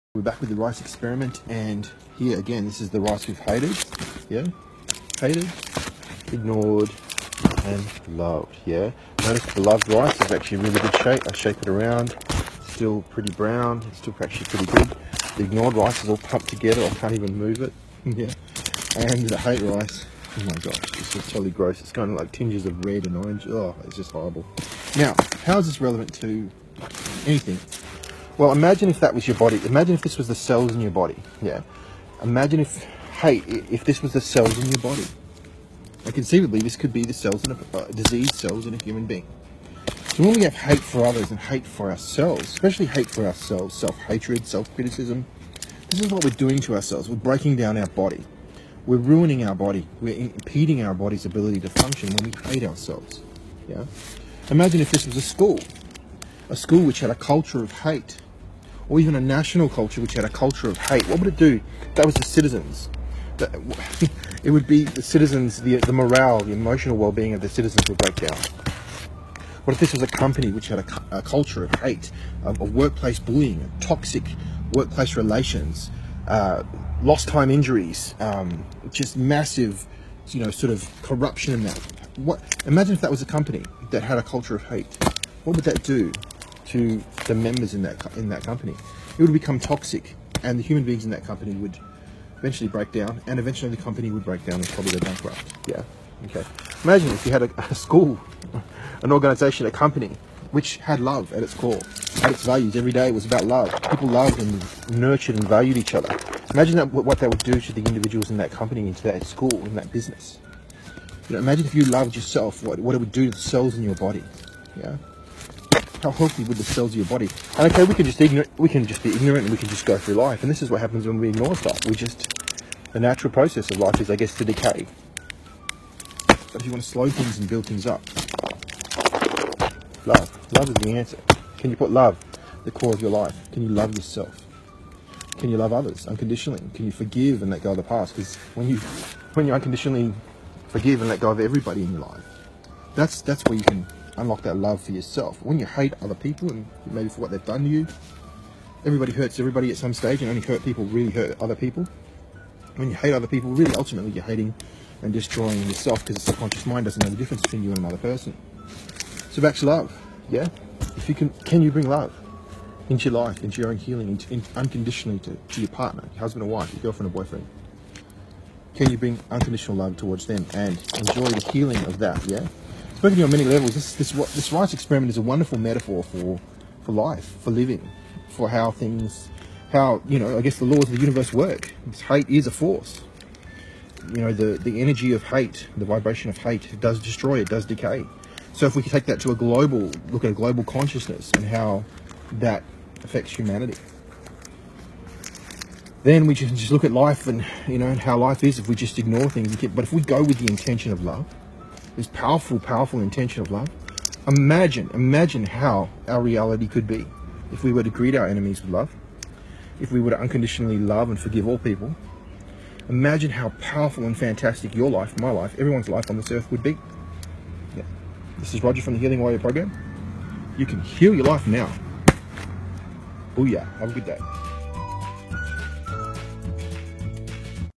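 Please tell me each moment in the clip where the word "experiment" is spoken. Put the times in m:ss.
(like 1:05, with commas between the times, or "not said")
0:00, 2:54.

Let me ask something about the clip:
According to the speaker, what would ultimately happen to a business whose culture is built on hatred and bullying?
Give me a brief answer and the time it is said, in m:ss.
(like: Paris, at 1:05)
go bankrupt, at 1:34.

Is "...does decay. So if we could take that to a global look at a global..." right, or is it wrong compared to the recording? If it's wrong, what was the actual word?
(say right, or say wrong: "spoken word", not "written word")
right.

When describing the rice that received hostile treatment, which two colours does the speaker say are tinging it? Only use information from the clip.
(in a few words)
red and orange.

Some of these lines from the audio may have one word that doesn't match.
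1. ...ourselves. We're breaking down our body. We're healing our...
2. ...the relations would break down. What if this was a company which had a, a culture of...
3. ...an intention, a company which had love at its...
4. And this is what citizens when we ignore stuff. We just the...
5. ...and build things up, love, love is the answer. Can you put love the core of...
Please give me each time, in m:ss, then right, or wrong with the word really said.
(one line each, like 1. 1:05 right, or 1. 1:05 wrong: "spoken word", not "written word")
1. 0:46 wrong: "ruining", not "healing"
2. 1:07 wrong: "citizens", not "relations"
3. 1:39 wrong: "organization", not "intention"
4. 2:00 wrong: "happens", not "citizens"
5. 2:07 right.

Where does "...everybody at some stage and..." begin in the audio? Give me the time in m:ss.
2:29.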